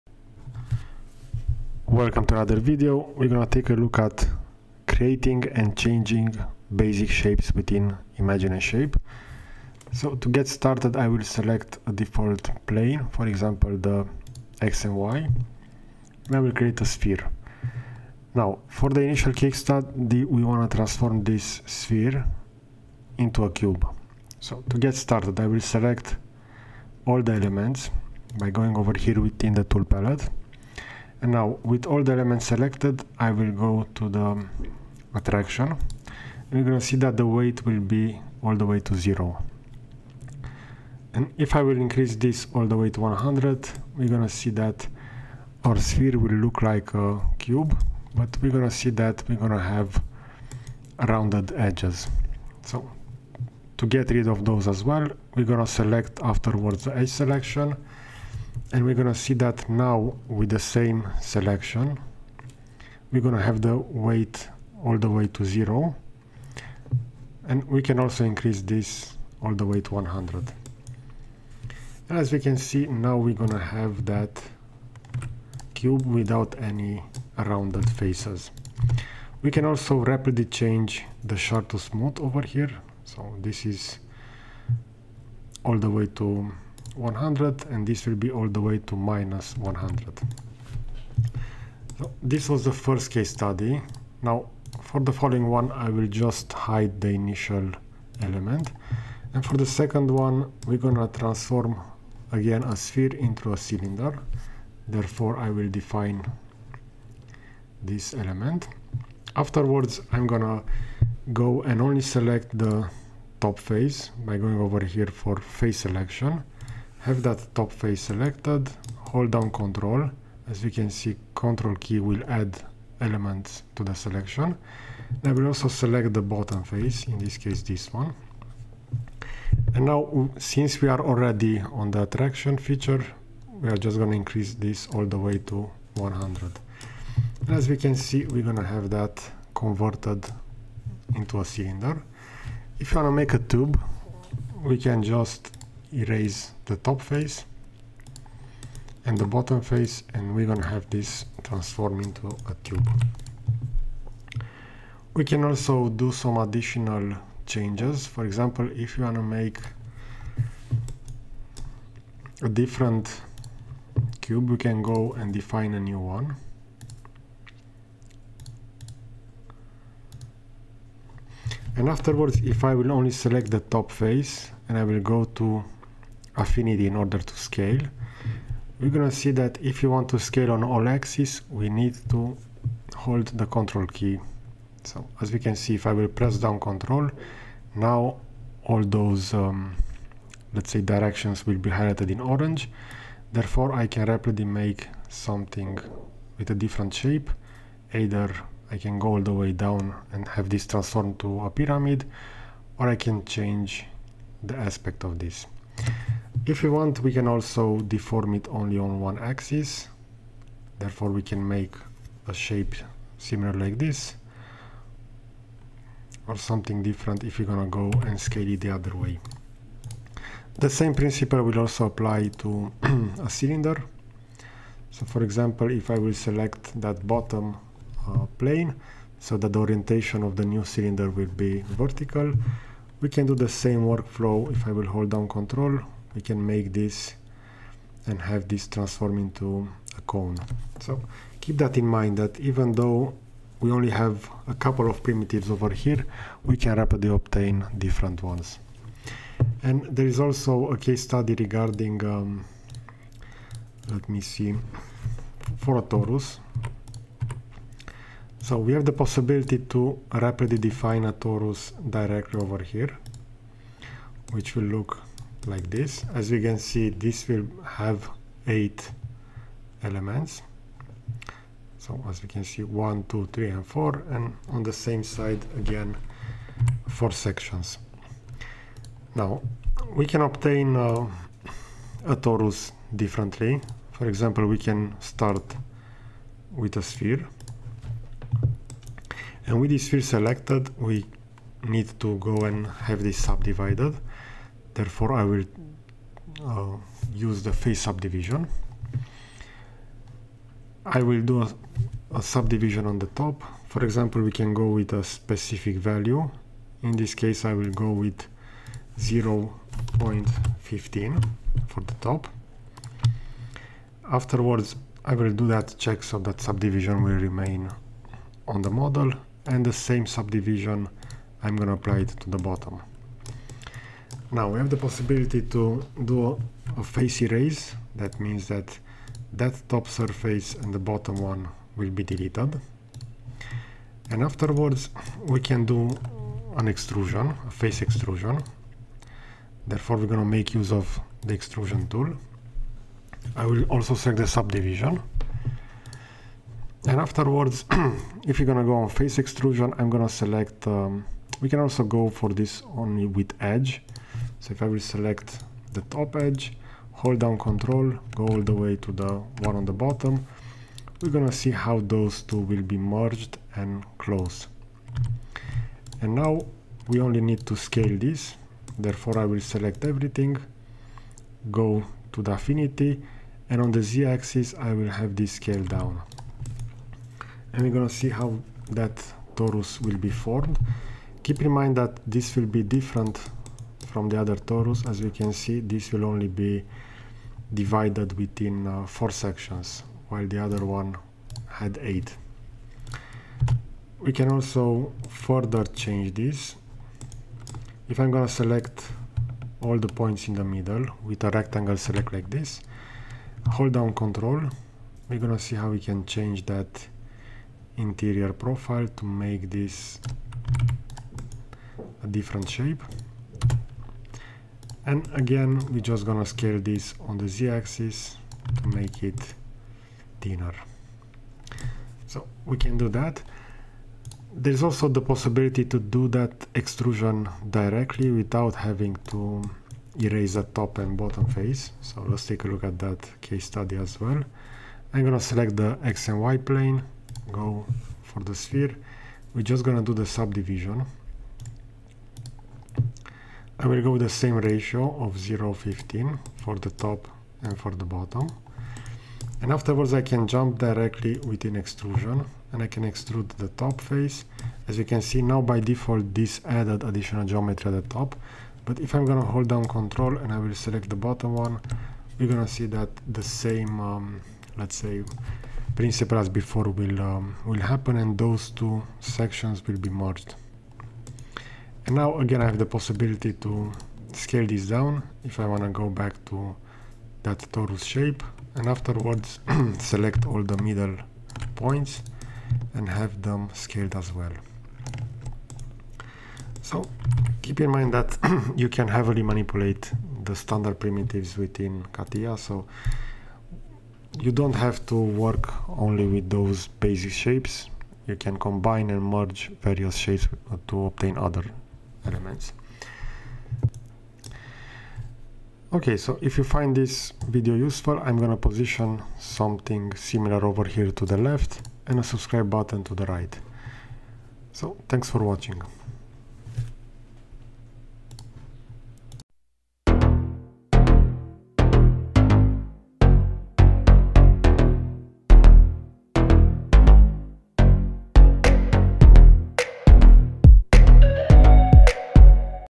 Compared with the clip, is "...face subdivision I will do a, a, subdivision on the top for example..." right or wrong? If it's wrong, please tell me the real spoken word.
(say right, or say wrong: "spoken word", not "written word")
right.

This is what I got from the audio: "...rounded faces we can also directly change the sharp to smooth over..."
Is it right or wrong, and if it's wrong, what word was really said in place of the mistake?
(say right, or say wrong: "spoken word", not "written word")
wrong: "rapidly", not "directly".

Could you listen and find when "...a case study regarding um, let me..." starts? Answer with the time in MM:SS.
04:10.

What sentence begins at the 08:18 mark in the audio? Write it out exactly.
You can combine and merge various shapes to obtain other elements.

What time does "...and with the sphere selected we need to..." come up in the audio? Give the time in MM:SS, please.
04:49.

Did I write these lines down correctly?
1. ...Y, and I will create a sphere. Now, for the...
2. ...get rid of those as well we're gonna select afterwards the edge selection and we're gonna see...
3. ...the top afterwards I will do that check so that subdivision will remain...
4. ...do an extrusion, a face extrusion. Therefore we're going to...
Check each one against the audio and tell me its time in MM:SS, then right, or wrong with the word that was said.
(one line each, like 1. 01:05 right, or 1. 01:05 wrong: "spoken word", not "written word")
1. 00:14 right
2. 00:53 right
3. 05:11 right
4. 05:35 right.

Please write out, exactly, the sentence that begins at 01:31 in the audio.
So this was the first case study.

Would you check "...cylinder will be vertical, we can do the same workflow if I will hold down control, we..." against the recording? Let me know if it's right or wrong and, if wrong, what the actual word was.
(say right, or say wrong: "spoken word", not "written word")
right.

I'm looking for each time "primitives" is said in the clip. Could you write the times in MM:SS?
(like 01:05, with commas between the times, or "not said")
04:05, 08:10.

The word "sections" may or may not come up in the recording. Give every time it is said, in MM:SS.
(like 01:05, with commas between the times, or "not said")
04:37, 06:29, 07:49.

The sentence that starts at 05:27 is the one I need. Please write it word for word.
That means that that top surface and the bottom one will be deleted.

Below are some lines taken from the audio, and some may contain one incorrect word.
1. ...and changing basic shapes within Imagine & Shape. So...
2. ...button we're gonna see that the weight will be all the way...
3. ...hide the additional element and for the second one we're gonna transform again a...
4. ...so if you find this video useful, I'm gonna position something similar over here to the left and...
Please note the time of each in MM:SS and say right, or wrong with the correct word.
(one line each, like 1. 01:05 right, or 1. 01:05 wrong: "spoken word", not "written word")
1. 00:05 right
2. 00:35 wrong: "attraction", not "button"
3. 01:36 wrong: "initial", not "additional"
4. 08:25 right.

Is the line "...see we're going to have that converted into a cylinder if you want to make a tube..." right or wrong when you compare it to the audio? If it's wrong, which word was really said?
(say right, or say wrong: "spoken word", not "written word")
right.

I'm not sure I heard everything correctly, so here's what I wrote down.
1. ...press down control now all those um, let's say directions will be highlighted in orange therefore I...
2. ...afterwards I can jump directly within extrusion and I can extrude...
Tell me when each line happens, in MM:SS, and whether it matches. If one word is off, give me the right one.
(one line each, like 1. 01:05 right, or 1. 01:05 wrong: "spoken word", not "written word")
1. 03:06 right
2. 07:29 right.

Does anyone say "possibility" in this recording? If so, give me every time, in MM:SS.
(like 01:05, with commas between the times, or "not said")
04:18, 05:24, 07:05, 07:52.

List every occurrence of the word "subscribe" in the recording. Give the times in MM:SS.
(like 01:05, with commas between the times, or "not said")
08:32.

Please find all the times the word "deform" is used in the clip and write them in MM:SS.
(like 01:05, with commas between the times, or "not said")
03:27.